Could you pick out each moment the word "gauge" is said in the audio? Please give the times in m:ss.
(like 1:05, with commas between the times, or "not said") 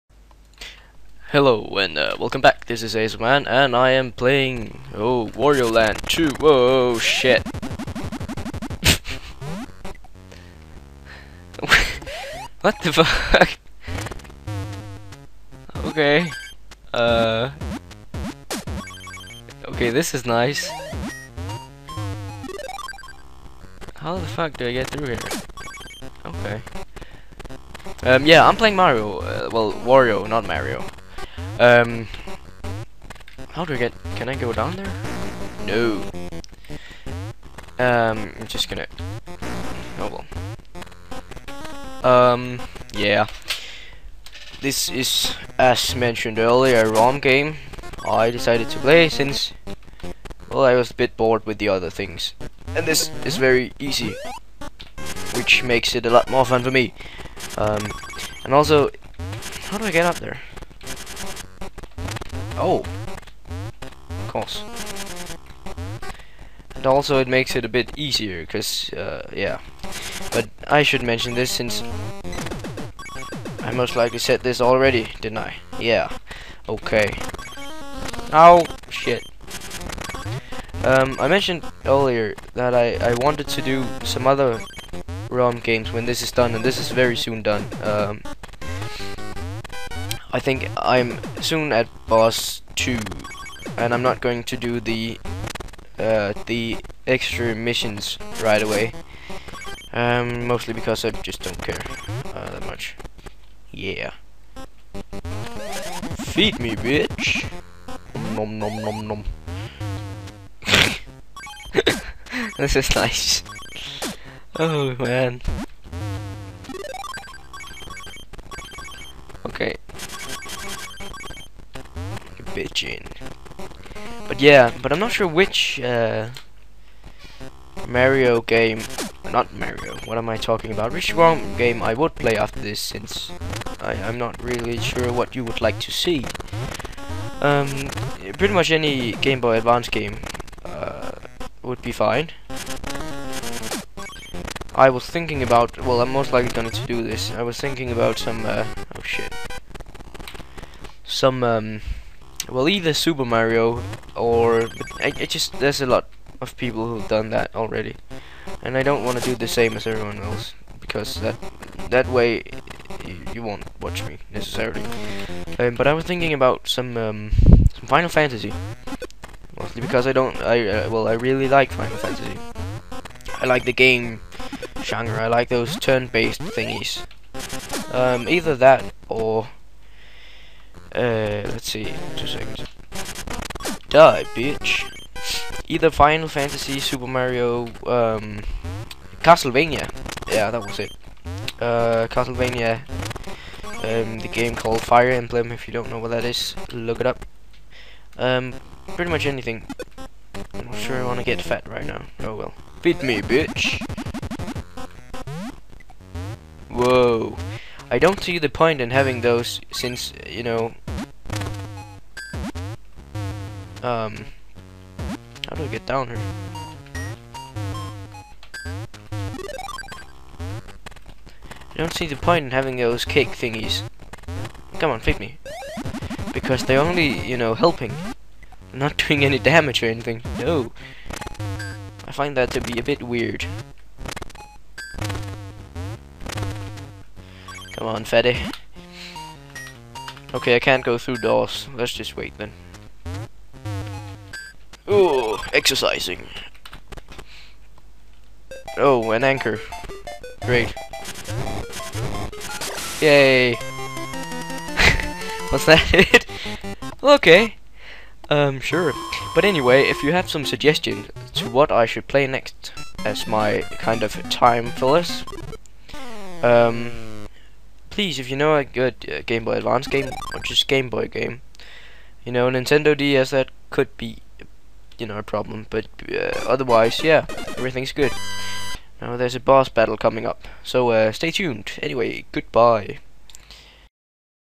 not said.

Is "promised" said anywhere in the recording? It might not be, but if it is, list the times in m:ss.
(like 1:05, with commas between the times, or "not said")
not said.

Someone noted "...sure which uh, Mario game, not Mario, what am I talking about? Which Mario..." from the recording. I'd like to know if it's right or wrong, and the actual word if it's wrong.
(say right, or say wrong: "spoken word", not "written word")
wrong: "ROM", not "Mario".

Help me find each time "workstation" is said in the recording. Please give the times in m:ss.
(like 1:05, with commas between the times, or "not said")
not said.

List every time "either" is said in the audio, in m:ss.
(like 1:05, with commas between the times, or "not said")
2:32, 2:58, 3:05.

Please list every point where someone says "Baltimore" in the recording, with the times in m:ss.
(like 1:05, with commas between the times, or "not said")
not said.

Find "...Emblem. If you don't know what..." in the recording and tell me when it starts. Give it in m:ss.
3:15.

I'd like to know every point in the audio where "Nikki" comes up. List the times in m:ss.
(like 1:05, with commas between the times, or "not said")
not said.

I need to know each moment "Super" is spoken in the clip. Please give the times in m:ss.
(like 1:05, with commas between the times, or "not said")
2:32, 3:06.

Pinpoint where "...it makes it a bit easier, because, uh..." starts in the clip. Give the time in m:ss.
1:07.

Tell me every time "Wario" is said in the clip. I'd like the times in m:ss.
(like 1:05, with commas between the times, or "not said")
0:05, 0:29.